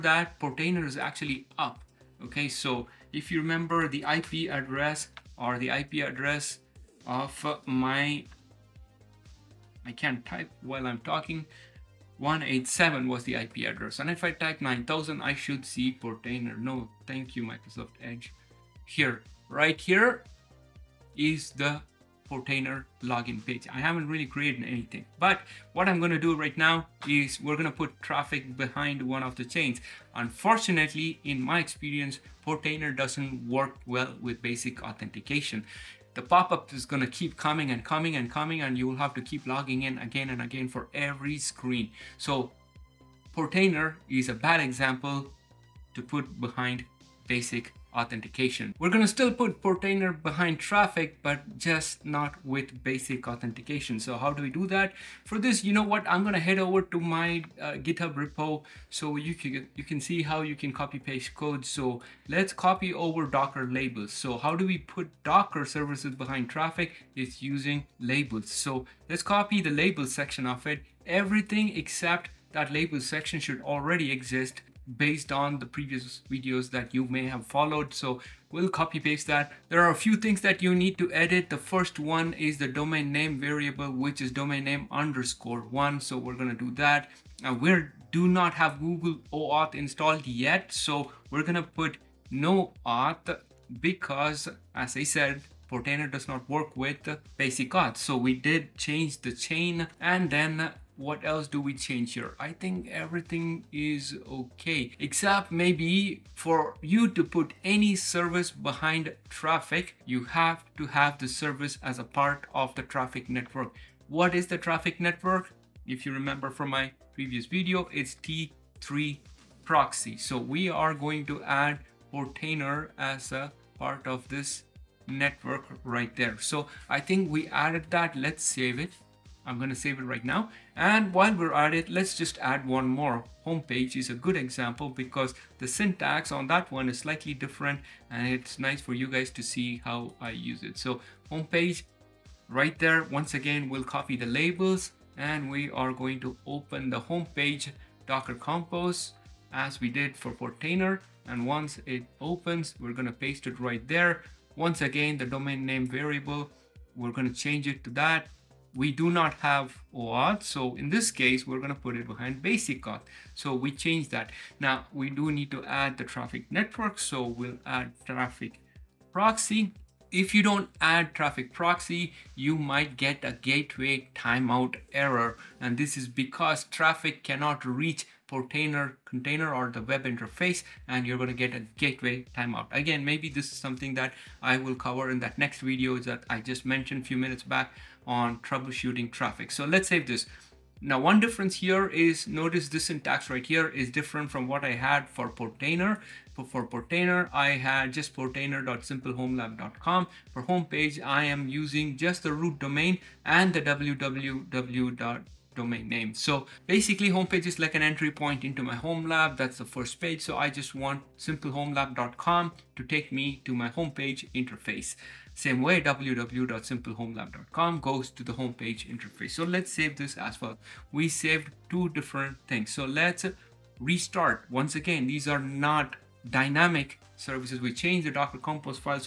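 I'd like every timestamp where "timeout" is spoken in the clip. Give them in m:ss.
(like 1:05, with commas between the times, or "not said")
2:54, 3:02.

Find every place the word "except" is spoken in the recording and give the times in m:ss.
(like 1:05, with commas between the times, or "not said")
1:11, 1:44.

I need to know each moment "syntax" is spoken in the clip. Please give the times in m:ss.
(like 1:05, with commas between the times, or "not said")
2:15, 3:12.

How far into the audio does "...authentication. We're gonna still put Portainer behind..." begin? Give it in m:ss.
0:47.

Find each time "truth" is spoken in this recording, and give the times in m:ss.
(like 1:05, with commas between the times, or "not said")
not said.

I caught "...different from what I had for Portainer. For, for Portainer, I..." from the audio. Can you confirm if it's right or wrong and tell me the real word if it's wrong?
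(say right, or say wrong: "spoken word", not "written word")
right.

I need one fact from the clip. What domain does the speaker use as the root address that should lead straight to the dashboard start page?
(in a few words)
simplehomelab.com.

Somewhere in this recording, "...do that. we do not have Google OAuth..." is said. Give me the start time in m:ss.
1:26.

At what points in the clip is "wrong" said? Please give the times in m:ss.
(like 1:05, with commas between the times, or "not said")
not said.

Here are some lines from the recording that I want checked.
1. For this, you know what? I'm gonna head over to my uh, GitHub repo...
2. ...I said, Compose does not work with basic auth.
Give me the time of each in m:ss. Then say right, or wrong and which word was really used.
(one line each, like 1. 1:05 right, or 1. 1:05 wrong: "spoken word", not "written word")
1. 0:55 right
2. 1:34 wrong: "Portainer", not "Compose".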